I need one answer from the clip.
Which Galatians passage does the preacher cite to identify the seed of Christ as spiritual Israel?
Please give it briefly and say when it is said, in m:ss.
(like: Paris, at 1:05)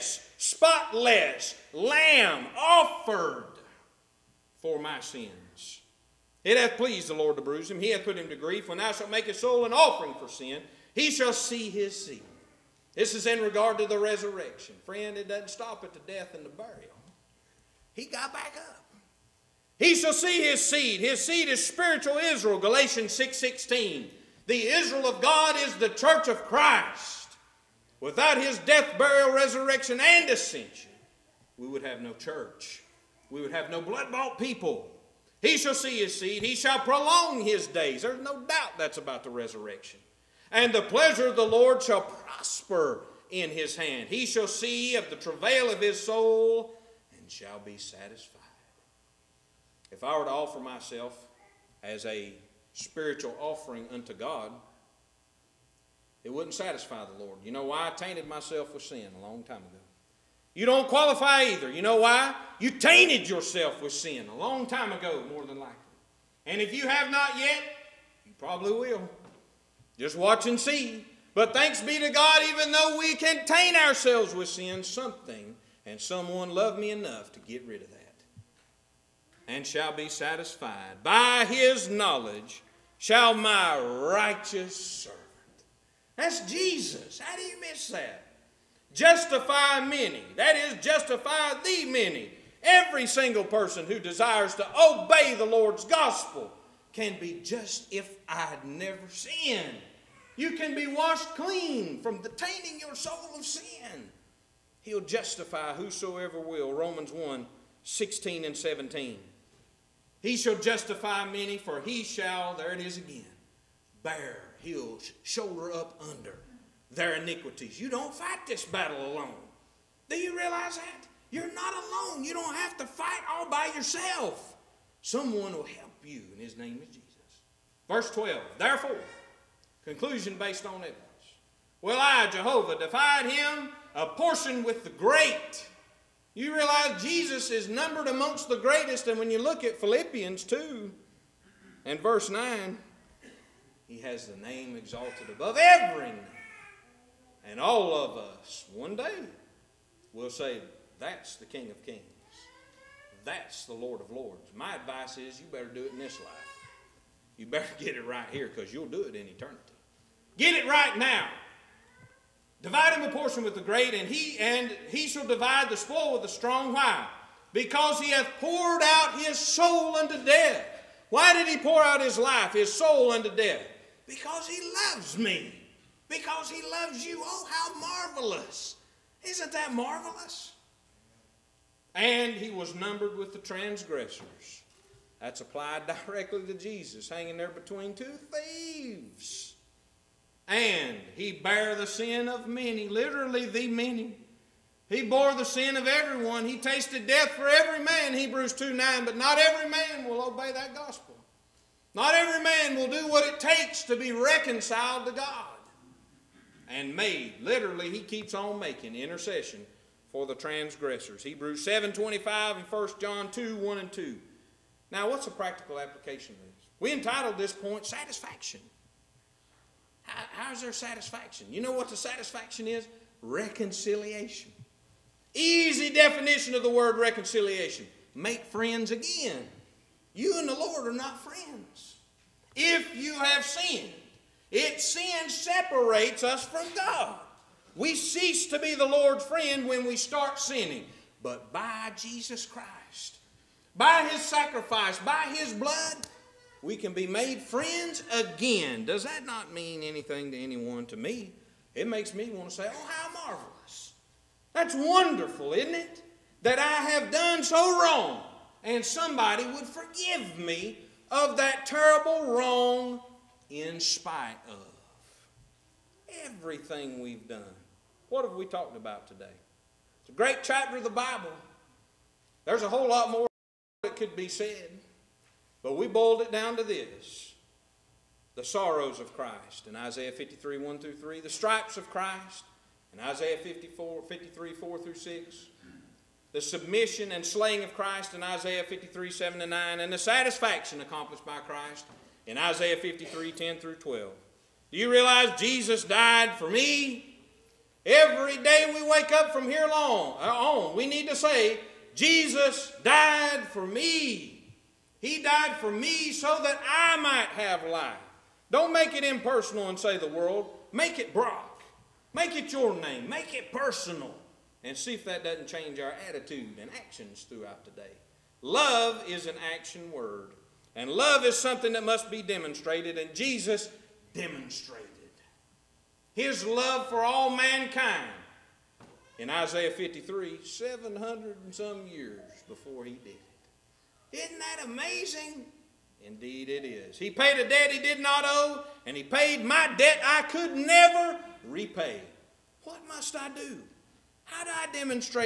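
Galatians 6:16, at 0:22.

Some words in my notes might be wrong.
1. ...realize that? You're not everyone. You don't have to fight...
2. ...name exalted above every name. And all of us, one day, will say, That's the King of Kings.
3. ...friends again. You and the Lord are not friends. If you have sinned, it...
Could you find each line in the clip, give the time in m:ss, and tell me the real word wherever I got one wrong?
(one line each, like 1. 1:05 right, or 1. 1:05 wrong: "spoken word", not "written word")
1. 2:00 wrong: "alone", not "everyone"
2. 2:24 right
3. 3:48 right.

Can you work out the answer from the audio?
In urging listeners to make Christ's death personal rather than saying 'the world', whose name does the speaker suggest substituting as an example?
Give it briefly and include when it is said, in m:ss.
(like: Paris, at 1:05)
Brock, at 5:11.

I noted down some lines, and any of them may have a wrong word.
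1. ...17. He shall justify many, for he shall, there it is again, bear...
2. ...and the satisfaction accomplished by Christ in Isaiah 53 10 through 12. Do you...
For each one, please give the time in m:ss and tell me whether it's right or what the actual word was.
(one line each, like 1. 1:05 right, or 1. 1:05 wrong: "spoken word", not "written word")
1. 1:48 right
2. 4:49 right.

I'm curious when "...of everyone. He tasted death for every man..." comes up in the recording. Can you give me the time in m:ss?
3:15.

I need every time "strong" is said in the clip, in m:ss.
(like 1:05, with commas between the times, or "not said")
2:46.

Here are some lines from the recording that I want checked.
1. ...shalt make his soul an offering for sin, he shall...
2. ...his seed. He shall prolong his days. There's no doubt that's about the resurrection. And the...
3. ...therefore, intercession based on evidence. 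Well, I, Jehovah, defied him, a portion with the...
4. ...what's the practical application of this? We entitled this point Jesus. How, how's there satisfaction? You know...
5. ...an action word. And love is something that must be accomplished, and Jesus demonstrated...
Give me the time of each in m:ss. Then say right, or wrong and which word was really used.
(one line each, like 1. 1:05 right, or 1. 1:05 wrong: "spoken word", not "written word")
1. 0:08 right
2. 0:35 right
3. 2:08 wrong: "conclusion", not "intercession"
4. 3:35 wrong: "Satisfaction", not "Jesus"
5. 5:19 wrong: "demonstrated", not "accomplished".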